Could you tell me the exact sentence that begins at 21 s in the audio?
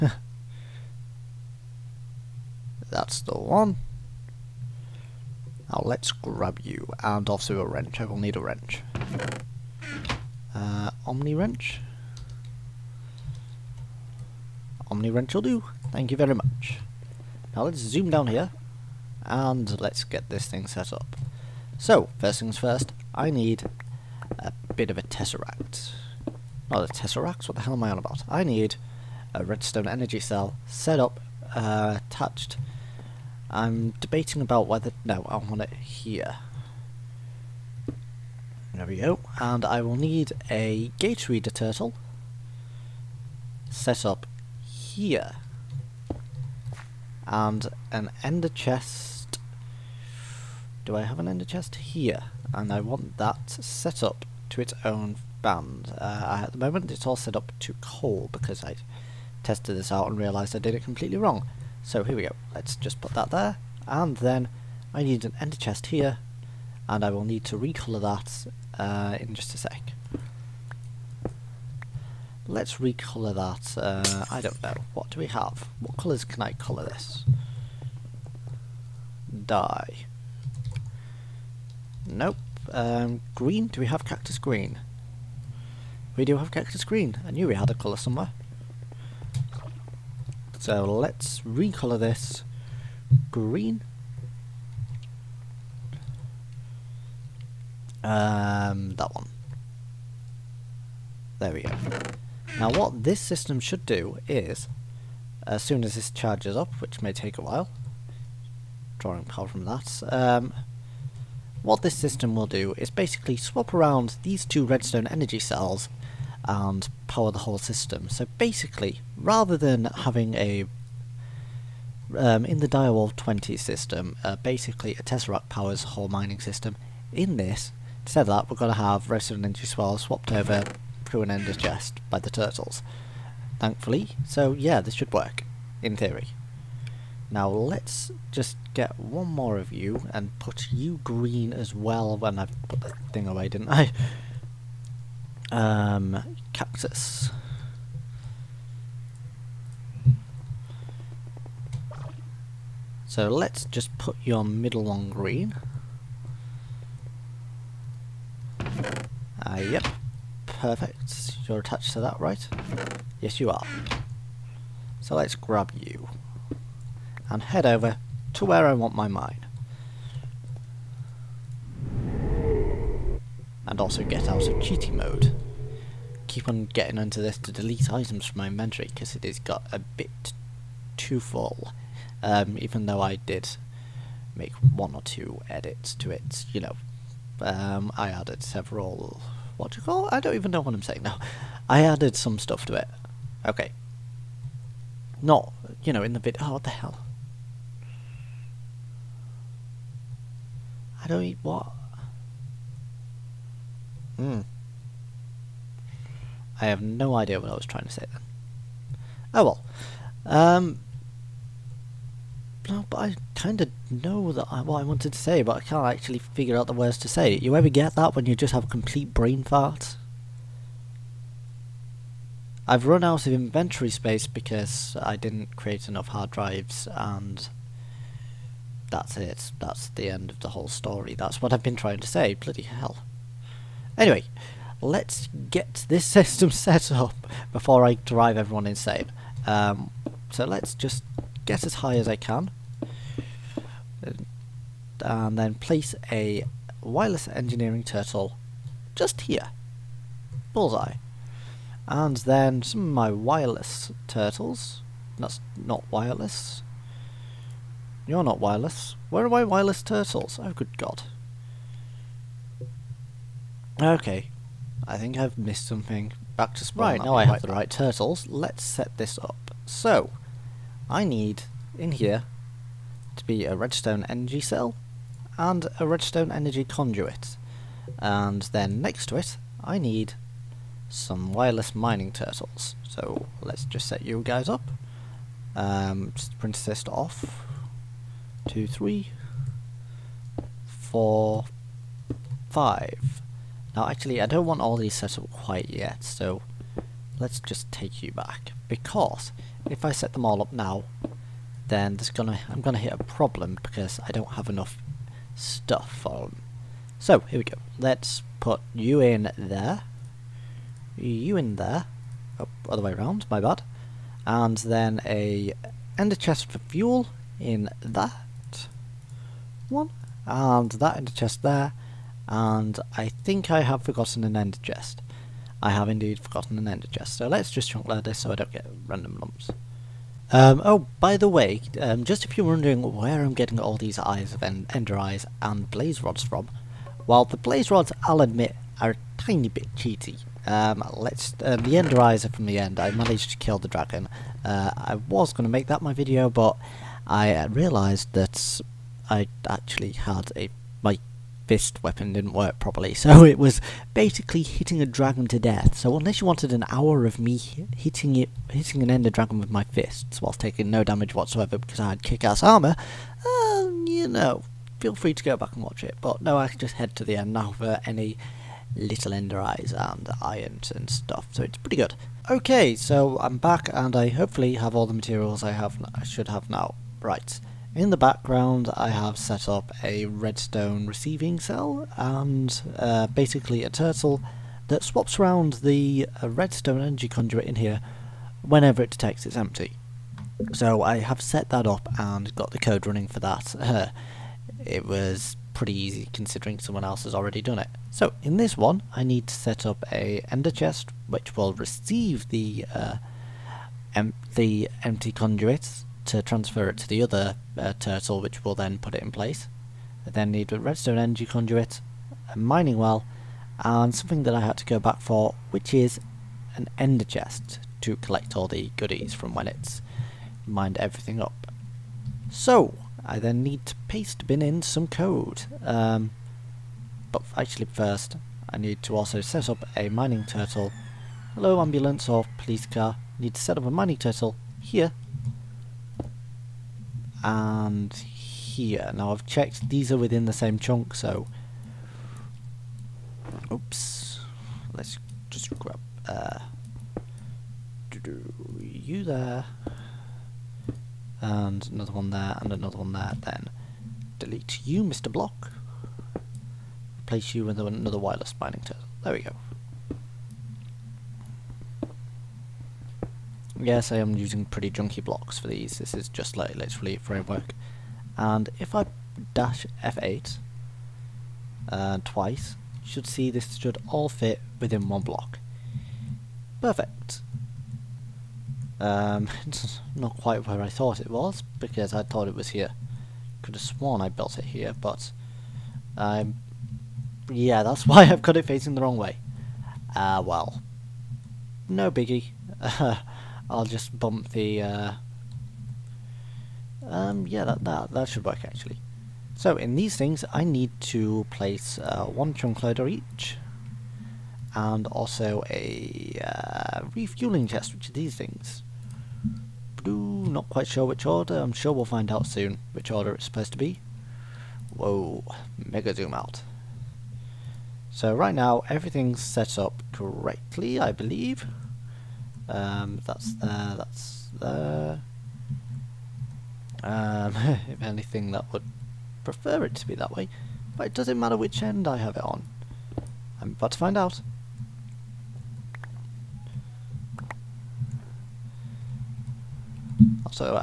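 So, first things first, I need a bit of a tesseract.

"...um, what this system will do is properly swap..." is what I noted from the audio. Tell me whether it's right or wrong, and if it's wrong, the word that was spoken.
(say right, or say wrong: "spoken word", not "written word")
wrong: "basically", not "properly".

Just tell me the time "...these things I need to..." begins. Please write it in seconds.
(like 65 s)
499 s.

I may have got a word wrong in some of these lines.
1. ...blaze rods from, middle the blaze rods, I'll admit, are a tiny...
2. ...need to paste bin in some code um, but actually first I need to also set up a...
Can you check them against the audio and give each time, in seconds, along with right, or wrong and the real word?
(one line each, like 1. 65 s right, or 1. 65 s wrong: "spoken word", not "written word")
1. 335 s wrong: "while", not "middle"
2. 423 s right.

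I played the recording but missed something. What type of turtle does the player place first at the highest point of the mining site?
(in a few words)
Wireless engineering turtle.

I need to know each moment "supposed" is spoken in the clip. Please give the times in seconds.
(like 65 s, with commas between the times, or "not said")
513 s.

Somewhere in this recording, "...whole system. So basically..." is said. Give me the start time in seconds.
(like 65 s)
117 s.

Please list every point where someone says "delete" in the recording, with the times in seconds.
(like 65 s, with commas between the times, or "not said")
177 s, 454 s.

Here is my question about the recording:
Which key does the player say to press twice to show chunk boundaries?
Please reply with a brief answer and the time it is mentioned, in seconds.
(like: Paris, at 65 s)
F8, at 469 s.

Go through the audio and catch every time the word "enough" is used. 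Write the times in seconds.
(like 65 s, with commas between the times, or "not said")
225 s, 304 s.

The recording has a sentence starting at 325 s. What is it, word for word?
I have indeed forgotten an ender chest, so let's just chunk loader so I don't get random lumps.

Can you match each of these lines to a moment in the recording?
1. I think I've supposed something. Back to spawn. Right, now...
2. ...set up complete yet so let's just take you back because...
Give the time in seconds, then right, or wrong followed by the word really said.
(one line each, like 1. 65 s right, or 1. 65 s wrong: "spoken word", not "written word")
1. 264 s wrong: "missed", not "supposed"
2. 294 s wrong: "quite", not "complete".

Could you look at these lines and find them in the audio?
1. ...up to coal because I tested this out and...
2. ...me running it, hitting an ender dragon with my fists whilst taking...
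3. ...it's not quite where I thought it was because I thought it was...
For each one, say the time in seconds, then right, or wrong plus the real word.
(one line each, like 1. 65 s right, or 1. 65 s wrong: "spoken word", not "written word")
1. 57 s right
2. 357 s wrong: "hitting", not "running"
3. 479 s right.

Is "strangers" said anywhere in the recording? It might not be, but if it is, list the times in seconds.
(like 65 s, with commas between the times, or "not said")
not said.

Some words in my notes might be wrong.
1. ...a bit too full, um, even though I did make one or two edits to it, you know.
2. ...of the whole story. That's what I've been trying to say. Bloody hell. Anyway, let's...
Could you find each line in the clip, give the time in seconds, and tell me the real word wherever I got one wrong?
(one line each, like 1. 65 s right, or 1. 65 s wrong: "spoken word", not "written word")
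1. 179 s right
2. 230 s right.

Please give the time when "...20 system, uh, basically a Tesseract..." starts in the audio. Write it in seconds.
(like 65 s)
123 s.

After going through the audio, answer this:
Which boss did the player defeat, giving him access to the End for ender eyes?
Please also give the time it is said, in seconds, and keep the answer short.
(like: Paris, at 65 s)
The dragon, at 343 s.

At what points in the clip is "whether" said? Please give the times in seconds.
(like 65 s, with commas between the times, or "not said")
34 s.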